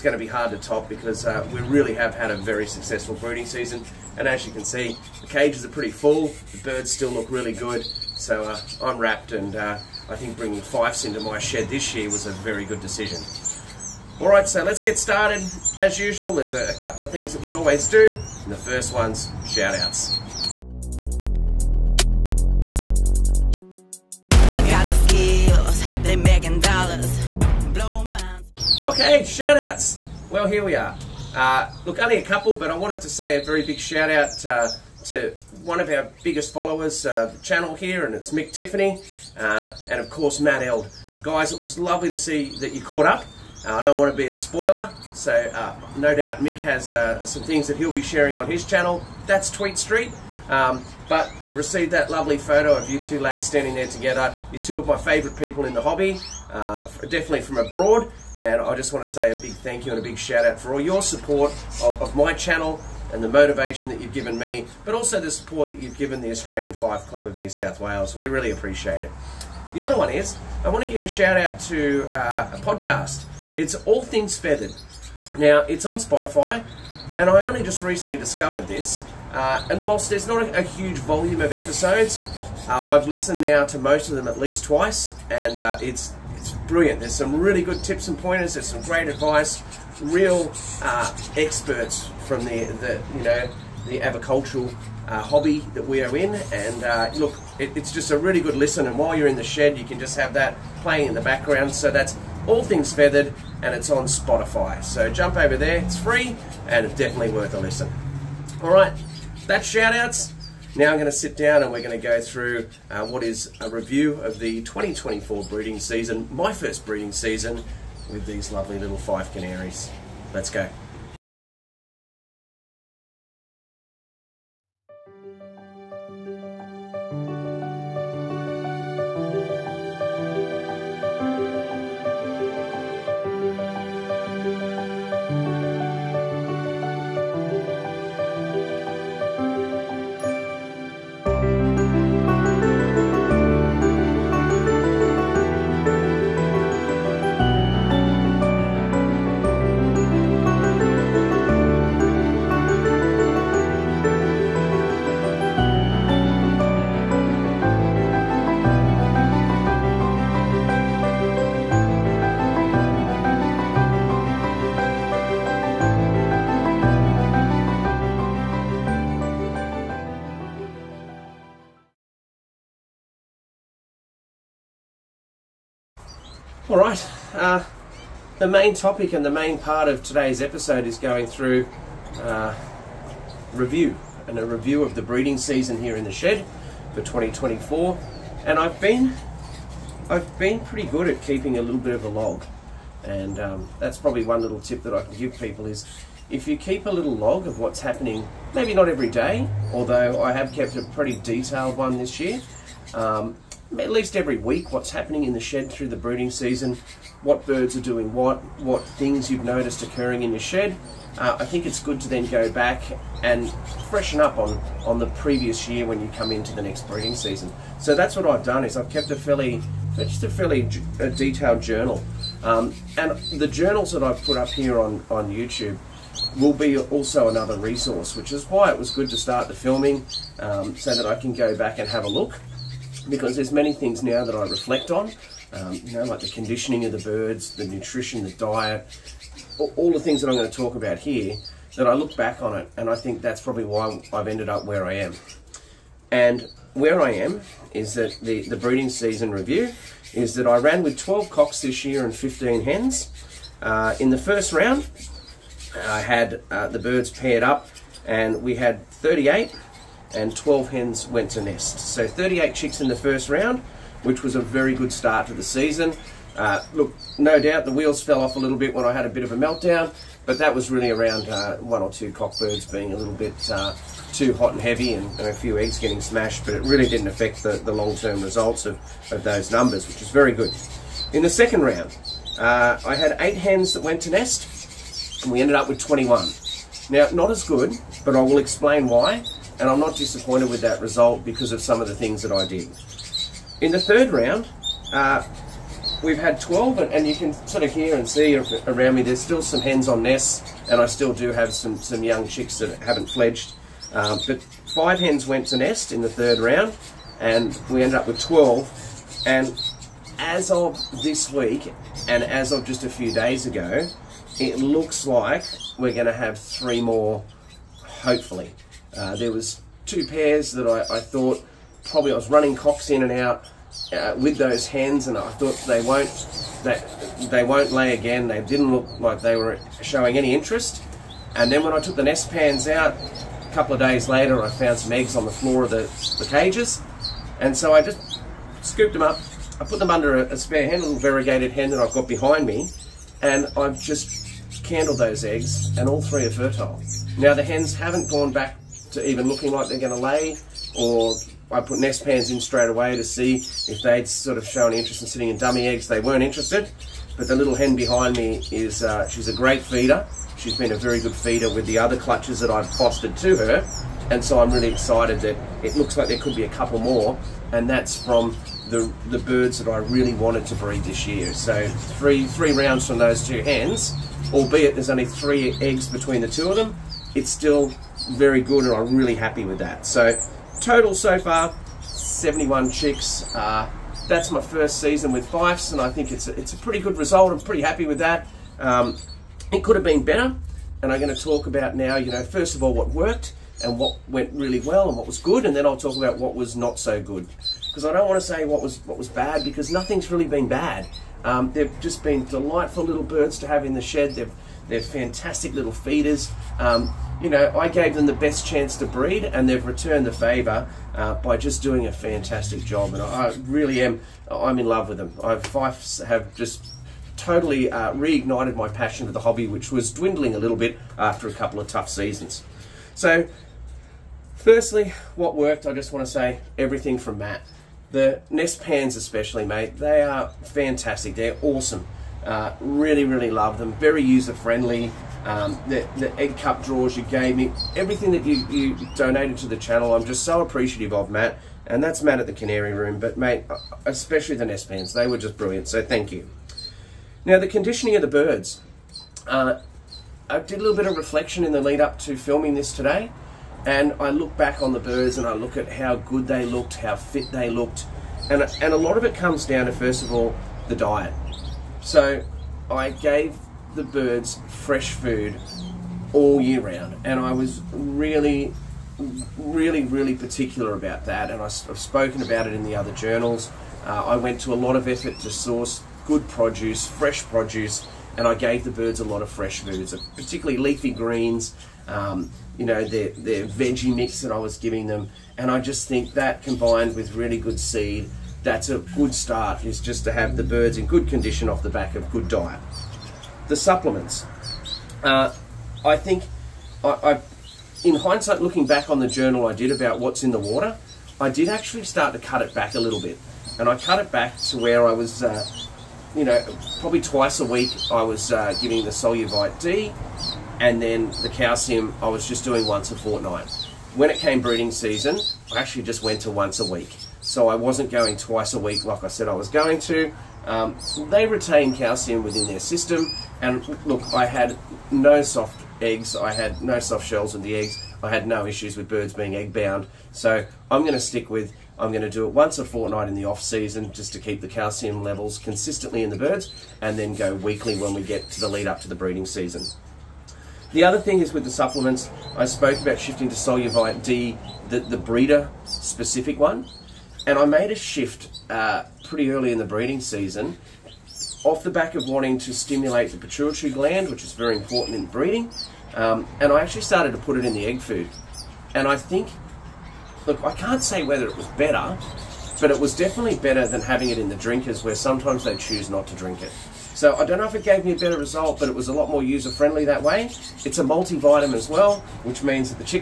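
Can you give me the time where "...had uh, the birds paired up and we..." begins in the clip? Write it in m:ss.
4:15.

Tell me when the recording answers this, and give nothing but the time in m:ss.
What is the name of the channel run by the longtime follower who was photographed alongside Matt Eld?
0:49.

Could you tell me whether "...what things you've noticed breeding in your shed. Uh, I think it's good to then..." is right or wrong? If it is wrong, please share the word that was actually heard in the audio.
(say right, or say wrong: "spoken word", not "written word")
wrong: "occurring", not "breeding".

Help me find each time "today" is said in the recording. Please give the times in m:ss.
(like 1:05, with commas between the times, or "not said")
3:00, 7:32.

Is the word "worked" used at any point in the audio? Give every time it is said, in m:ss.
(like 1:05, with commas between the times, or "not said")
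6:32, 7:05.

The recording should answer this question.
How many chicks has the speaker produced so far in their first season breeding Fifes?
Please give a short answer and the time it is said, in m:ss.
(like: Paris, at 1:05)
71, at 6:21.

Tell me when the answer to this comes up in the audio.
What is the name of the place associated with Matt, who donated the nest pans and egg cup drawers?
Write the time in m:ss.
7:22.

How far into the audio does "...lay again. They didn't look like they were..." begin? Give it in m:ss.
5:27.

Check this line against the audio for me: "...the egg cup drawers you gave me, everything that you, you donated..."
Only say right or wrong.
right.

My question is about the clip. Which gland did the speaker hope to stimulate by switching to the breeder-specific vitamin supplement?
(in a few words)
pituitary gland.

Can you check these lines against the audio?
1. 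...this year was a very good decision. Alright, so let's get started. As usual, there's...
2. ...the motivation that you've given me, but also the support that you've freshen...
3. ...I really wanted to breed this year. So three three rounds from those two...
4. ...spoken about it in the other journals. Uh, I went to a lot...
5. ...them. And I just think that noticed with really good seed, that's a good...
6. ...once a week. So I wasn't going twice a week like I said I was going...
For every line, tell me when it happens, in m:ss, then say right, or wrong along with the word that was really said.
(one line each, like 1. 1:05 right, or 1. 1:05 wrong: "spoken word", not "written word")
1. 0:11 right
2. 1:03 wrong: "given", not "freshen"
3. 6:09 right
4. 7:51 right
5. 8:04 wrong: "combined", not "noticed"
6. 8:36 right.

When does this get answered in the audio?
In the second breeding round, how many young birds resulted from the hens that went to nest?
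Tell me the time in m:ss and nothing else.
4:45.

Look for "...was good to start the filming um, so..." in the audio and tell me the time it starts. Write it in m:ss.
3:48.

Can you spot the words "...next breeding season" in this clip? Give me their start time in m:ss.
3:36.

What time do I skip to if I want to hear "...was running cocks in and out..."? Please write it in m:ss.
5:22.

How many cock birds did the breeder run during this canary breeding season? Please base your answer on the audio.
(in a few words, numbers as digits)
12.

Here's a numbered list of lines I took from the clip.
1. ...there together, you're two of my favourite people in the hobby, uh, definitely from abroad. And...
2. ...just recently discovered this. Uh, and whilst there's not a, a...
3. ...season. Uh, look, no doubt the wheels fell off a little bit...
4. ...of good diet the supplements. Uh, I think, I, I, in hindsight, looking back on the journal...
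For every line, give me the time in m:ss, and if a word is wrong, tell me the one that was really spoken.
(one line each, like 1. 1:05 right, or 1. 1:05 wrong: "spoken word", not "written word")
1. 0:53 right
2. 1:17 right
3. 4:25 right
4. 8:11 right.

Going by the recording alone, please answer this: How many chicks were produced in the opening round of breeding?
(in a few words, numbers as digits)
38.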